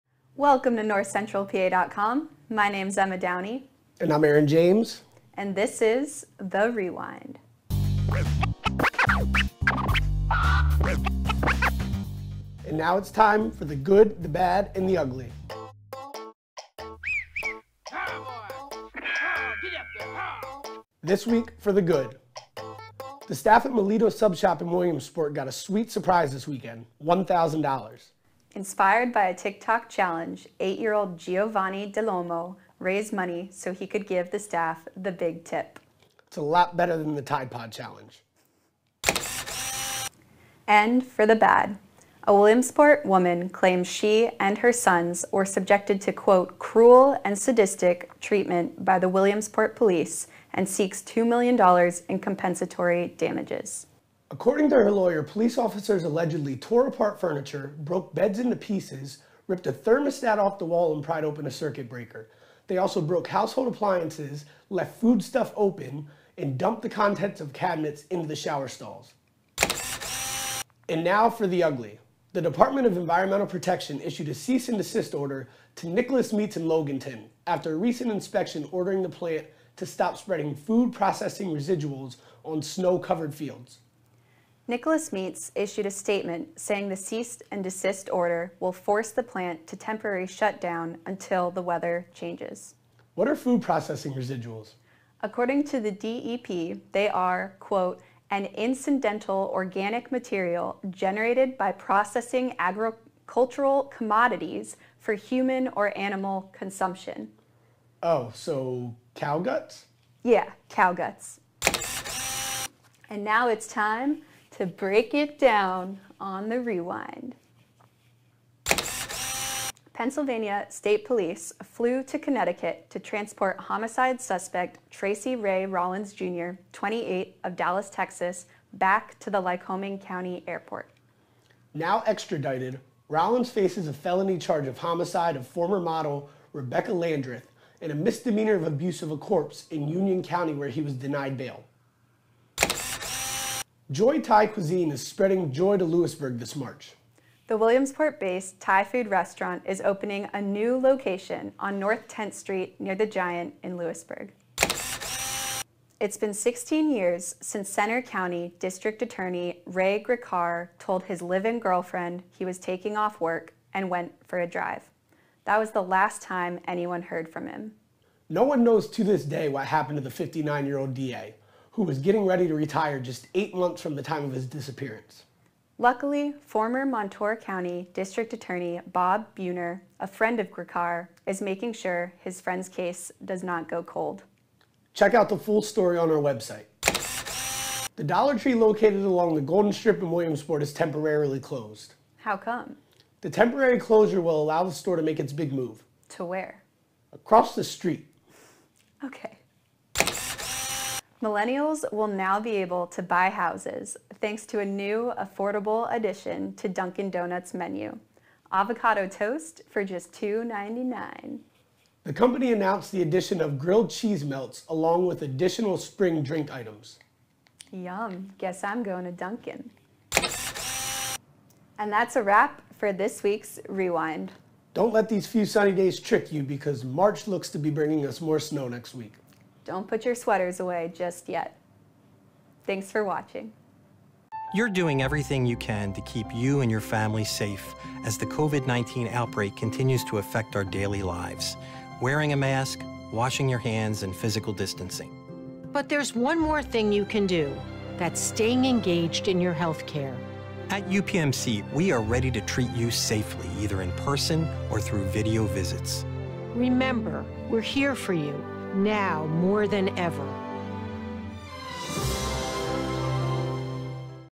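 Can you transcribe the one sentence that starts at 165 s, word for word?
That was the last time anyone heard from him.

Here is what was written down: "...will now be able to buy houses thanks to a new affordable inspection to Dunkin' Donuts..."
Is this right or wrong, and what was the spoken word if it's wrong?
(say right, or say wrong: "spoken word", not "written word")
wrong: "addition", not "inspection".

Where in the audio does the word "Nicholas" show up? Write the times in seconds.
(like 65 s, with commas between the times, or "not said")
75 s, 84 s.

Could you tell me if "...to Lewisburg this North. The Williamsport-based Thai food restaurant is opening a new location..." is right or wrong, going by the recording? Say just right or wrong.
wrong.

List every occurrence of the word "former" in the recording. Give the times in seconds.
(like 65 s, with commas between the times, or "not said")
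135 s, 176 s.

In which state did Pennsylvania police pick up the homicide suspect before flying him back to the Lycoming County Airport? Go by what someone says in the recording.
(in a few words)
Connecticut.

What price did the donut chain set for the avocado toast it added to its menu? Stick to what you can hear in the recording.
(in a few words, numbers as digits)
$2.99.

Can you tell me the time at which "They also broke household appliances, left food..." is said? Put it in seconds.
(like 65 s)
62 s.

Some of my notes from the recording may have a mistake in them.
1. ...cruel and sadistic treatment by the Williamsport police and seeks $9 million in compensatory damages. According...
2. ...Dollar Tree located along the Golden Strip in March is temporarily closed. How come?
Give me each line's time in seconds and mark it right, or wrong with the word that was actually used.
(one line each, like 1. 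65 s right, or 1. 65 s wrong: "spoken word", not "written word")
1. 46 s wrong: "2", not "9"
2. 188 s wrong: "Williamsport", not "March".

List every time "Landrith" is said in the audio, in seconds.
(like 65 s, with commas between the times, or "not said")
136 s.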